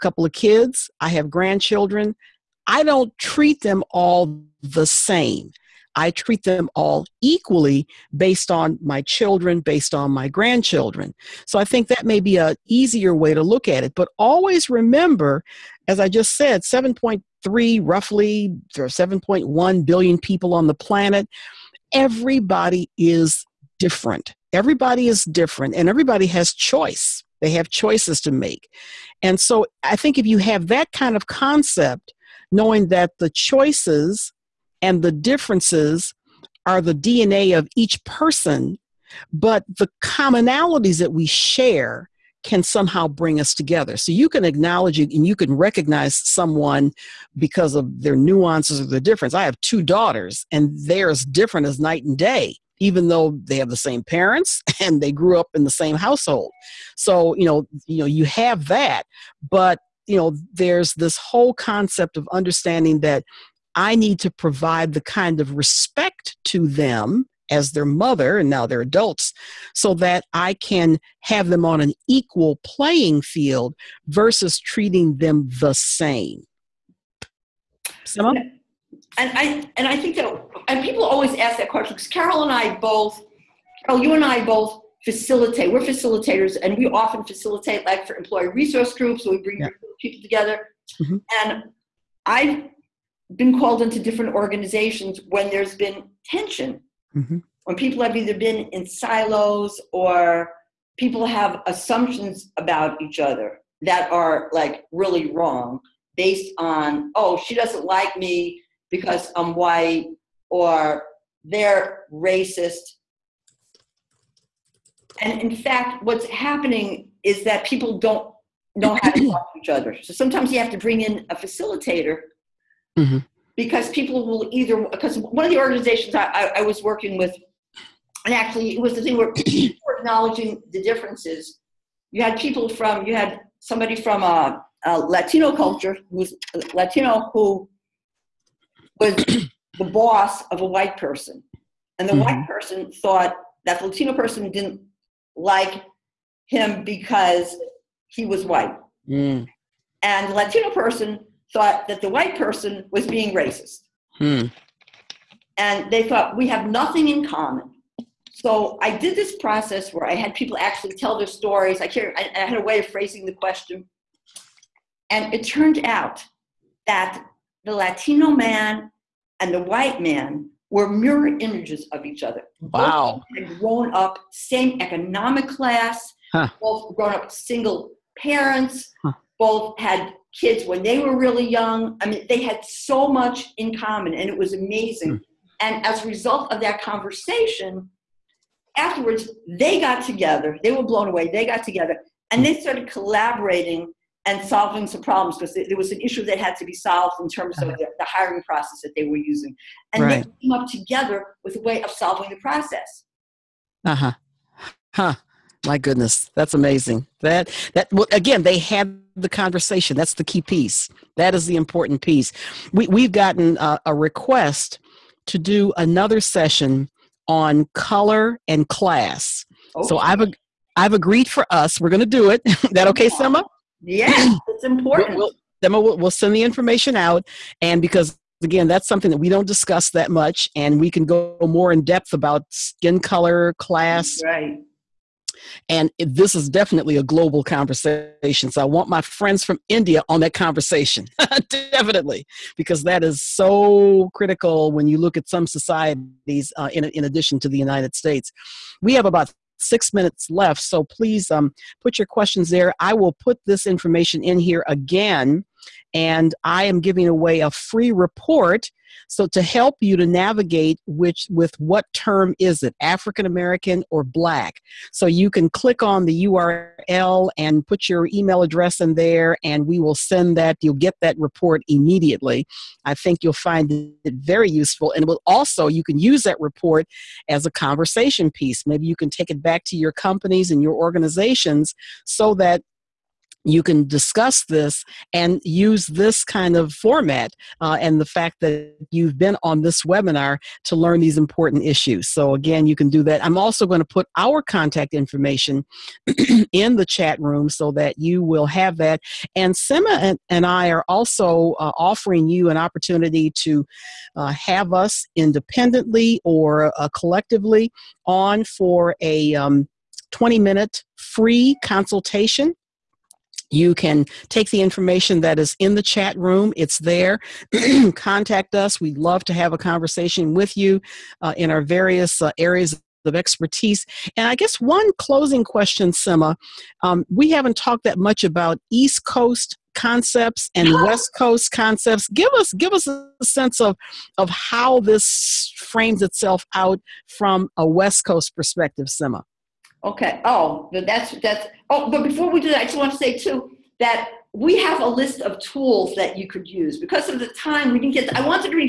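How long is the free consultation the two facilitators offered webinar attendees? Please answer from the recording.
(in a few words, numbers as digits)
20 minutes.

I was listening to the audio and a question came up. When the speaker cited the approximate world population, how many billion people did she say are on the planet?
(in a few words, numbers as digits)
7.1 billion.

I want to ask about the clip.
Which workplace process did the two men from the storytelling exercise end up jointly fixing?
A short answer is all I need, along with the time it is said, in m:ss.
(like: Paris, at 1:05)
The hiring process, at 3:18.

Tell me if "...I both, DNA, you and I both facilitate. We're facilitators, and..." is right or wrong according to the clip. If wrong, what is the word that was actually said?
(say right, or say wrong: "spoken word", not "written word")
wrong: "Carole", not "DNA".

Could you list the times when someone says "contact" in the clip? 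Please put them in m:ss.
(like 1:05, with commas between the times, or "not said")
4:54, 5:17.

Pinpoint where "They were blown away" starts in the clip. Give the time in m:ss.
3:10.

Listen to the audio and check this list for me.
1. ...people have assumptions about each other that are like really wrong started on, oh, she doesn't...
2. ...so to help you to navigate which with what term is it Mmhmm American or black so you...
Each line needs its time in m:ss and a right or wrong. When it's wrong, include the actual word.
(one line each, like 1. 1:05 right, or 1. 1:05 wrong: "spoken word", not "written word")
1. 1:40 wrong: "based", not "started"
2. 4:19 wrong: "African", not "Mmhmm".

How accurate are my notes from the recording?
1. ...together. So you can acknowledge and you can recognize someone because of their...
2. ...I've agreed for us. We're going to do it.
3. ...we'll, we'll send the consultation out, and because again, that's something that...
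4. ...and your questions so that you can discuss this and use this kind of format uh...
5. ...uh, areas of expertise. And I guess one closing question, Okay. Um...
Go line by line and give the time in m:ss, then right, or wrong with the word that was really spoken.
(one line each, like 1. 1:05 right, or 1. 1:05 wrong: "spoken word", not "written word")
1. 0:43 right
2. 3:40 right
3. 3:45 wrong: "information", not "consultation"
4. 4:40 wrong: "organizations", not "questions"
5. 5:22 wrong: "Sima", not "Okay".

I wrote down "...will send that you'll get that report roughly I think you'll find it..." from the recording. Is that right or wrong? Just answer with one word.
wrong.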